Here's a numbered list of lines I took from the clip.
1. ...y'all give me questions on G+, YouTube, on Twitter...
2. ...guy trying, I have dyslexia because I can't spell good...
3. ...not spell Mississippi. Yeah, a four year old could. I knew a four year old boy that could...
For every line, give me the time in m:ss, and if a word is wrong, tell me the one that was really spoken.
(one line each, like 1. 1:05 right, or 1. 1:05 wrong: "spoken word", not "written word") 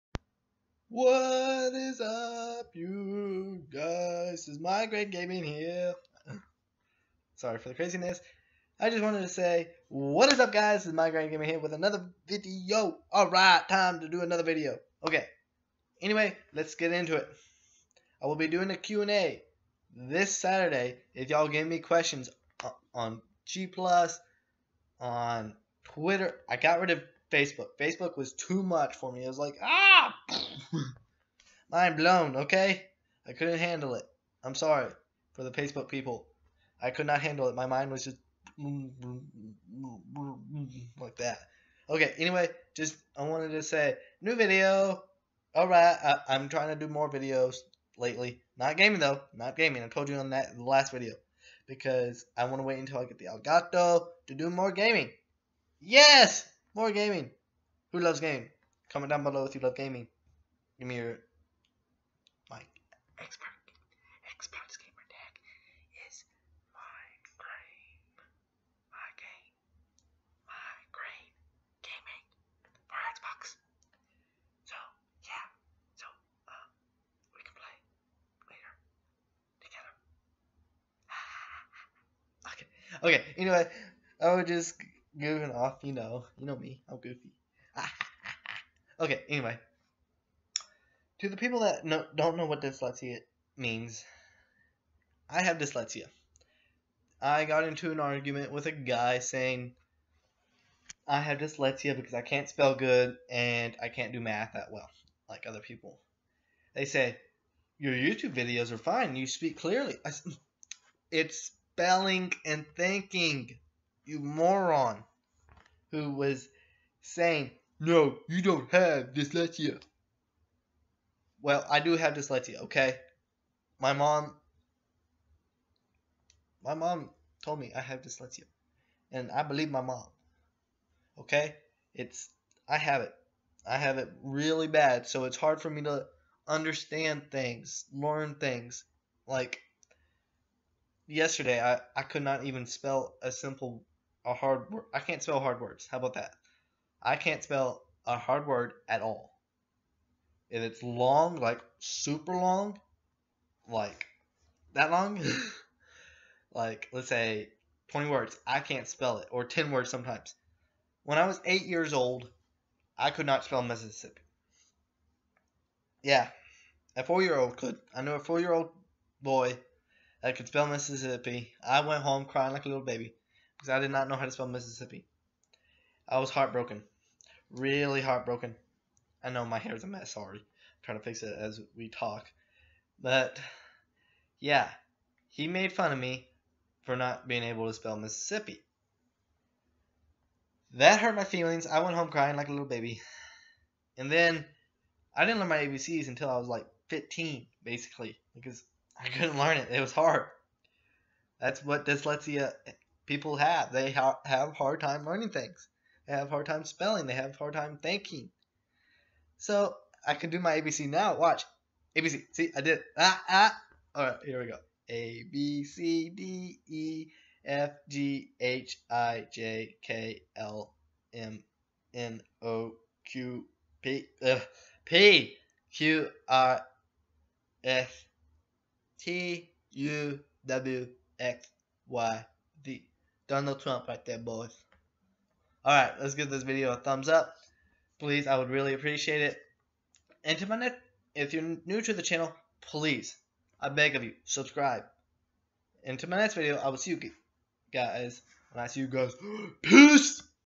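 1. 0:21 wrong: "Plus", not "YouTube"
2. 1:38 wrong: "saying", not "trying"
3. 2:43 right.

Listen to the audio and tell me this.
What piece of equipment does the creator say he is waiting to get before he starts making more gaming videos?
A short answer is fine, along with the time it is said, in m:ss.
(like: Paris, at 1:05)
Elgato, at 0:53.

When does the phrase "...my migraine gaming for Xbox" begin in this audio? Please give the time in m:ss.
1:10.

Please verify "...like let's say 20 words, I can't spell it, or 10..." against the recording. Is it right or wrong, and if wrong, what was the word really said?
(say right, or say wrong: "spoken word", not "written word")
right.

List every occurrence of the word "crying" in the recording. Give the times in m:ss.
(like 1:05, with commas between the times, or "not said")
2:52, 3:12.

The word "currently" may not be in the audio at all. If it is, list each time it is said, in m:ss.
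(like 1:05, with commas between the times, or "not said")
not said.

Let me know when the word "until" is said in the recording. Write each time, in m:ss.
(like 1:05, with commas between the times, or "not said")
0:52, 3:16.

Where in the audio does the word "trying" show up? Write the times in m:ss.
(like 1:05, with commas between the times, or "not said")
0:46, 3:00.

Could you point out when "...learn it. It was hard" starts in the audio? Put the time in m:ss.
3:19.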